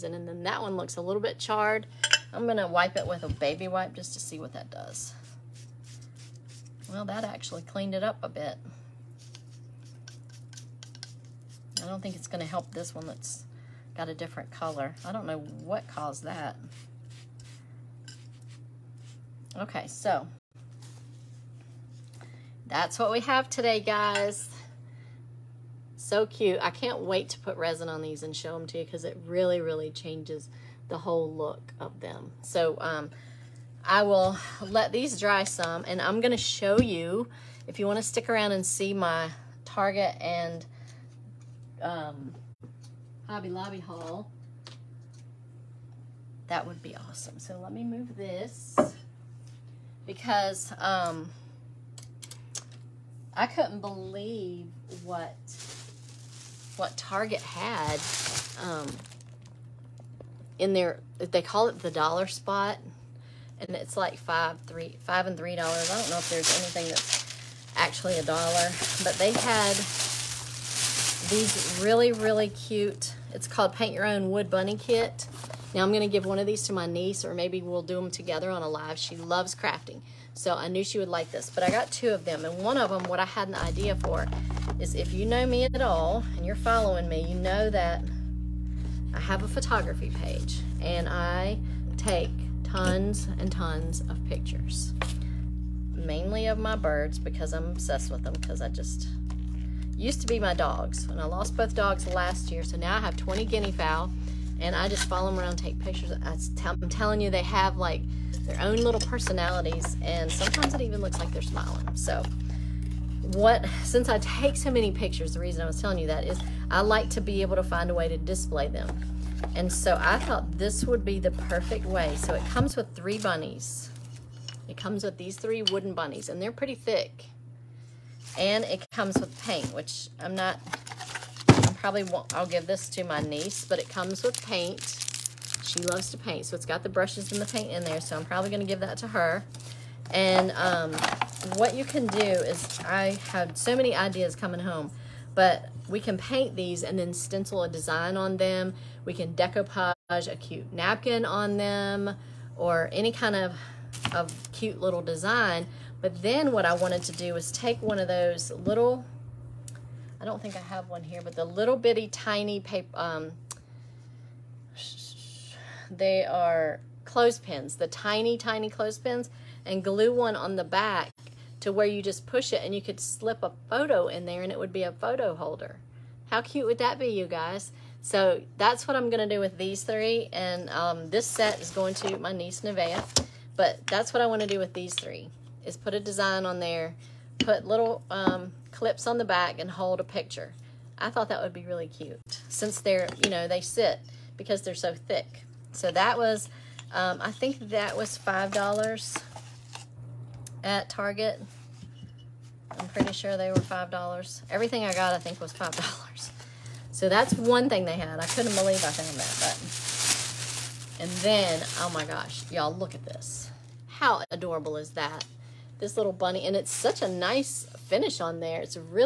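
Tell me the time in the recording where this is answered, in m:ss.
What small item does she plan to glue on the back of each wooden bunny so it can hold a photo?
2:47.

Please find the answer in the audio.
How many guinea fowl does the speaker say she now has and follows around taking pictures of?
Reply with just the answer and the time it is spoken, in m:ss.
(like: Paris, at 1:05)
20, at 1:43.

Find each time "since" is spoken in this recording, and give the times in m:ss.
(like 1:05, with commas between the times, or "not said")
1:53, 3:12.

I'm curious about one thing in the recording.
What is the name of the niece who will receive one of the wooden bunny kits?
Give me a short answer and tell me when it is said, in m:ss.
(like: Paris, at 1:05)
Nevaeh, at 3:02.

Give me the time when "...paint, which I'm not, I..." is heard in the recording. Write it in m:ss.
2:09.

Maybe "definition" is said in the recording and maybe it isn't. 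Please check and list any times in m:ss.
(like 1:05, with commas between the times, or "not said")
not said.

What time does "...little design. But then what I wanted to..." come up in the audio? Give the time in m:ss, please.
2:34.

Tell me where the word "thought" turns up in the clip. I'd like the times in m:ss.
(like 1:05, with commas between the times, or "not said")
2:00, 3:11.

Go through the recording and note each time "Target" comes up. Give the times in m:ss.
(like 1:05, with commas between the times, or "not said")
0:39, 0:56, 3:20.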